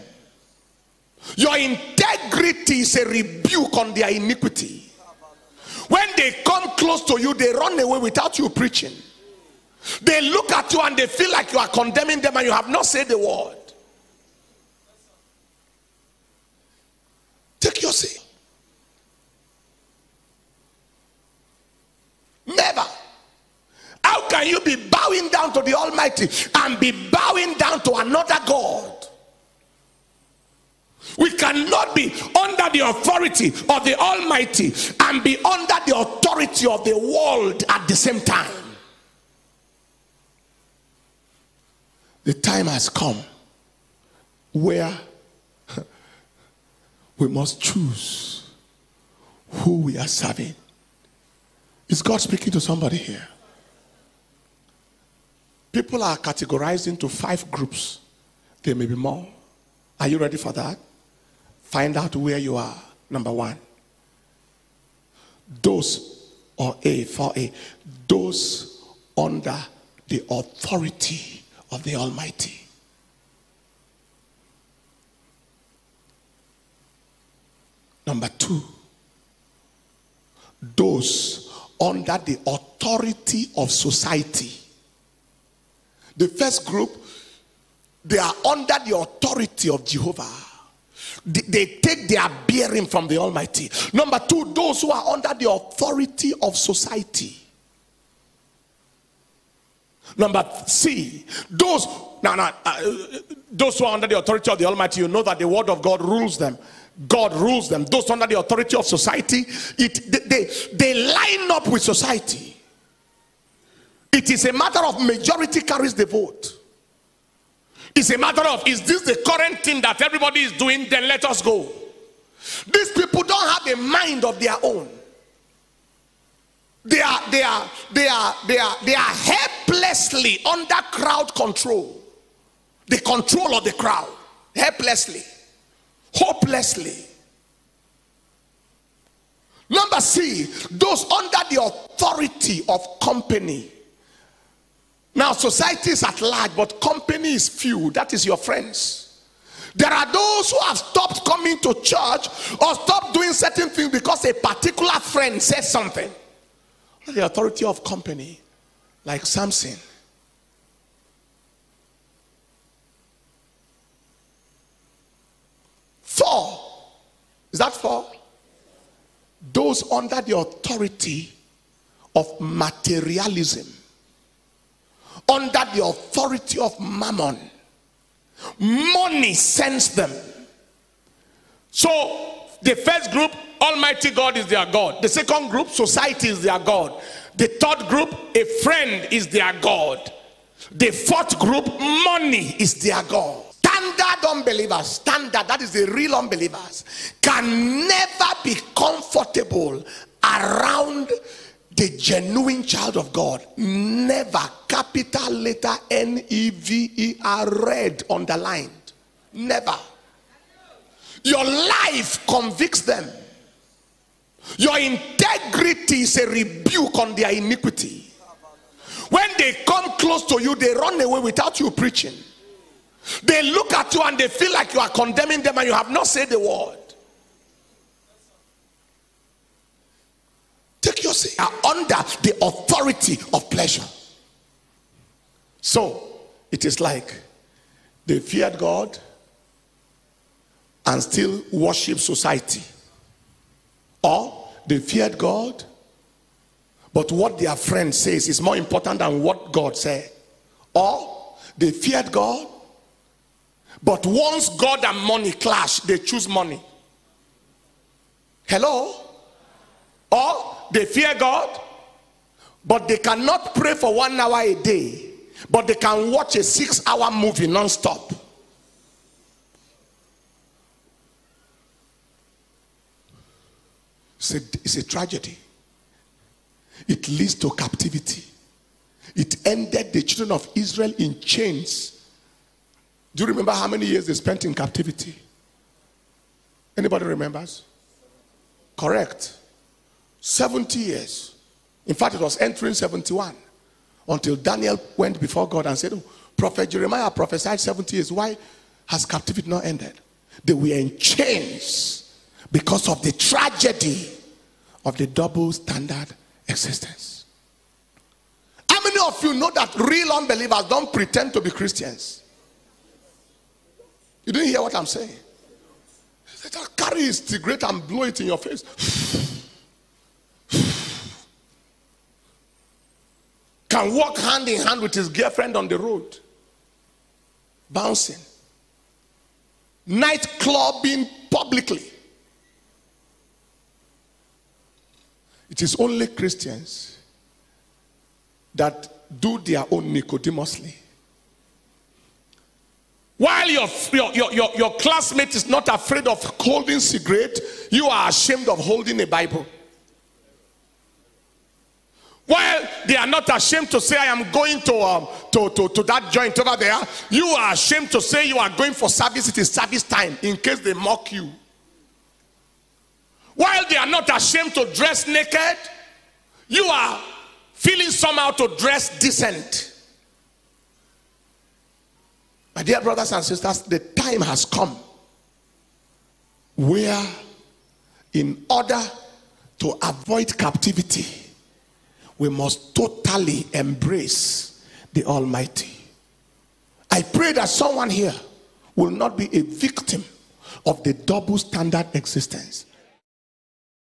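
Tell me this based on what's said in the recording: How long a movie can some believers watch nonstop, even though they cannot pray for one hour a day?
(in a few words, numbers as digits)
6 hours.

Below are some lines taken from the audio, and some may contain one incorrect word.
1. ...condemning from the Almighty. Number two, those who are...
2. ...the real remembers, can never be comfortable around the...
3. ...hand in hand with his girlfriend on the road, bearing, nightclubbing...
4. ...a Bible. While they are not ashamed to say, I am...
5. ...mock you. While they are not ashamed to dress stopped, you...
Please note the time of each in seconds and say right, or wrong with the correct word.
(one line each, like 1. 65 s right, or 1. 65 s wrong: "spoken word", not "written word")
1. 92 s wrong: "bearing", not "condemning"
2. 195 s wrong: "unbelievers", not "remembers"
3. 324 s wrong: "bouncing", not "bearing"
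4. 348 s right
5. 360 s wrong: "naked", not "stopped".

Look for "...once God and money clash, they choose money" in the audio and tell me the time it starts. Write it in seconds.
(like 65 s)
254 s.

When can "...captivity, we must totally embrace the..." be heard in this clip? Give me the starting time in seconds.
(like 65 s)
380 s.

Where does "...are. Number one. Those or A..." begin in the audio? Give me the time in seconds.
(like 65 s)
62 s.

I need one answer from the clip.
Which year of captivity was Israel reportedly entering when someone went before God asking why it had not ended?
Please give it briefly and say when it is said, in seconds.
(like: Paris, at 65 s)
71, at 292 s.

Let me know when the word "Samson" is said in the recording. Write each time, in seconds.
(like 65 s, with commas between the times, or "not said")
159 s.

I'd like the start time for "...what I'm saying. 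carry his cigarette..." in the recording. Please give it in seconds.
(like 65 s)
314 s.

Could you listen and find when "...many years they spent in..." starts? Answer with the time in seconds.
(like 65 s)
283 s.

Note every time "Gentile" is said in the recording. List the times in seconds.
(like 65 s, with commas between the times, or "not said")
not said.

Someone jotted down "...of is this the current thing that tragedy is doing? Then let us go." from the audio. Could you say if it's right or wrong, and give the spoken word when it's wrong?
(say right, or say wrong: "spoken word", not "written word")
wrong: "everybody", not "tragedy".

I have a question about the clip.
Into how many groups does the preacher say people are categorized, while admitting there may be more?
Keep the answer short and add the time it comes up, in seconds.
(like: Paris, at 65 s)
5, at 57 s.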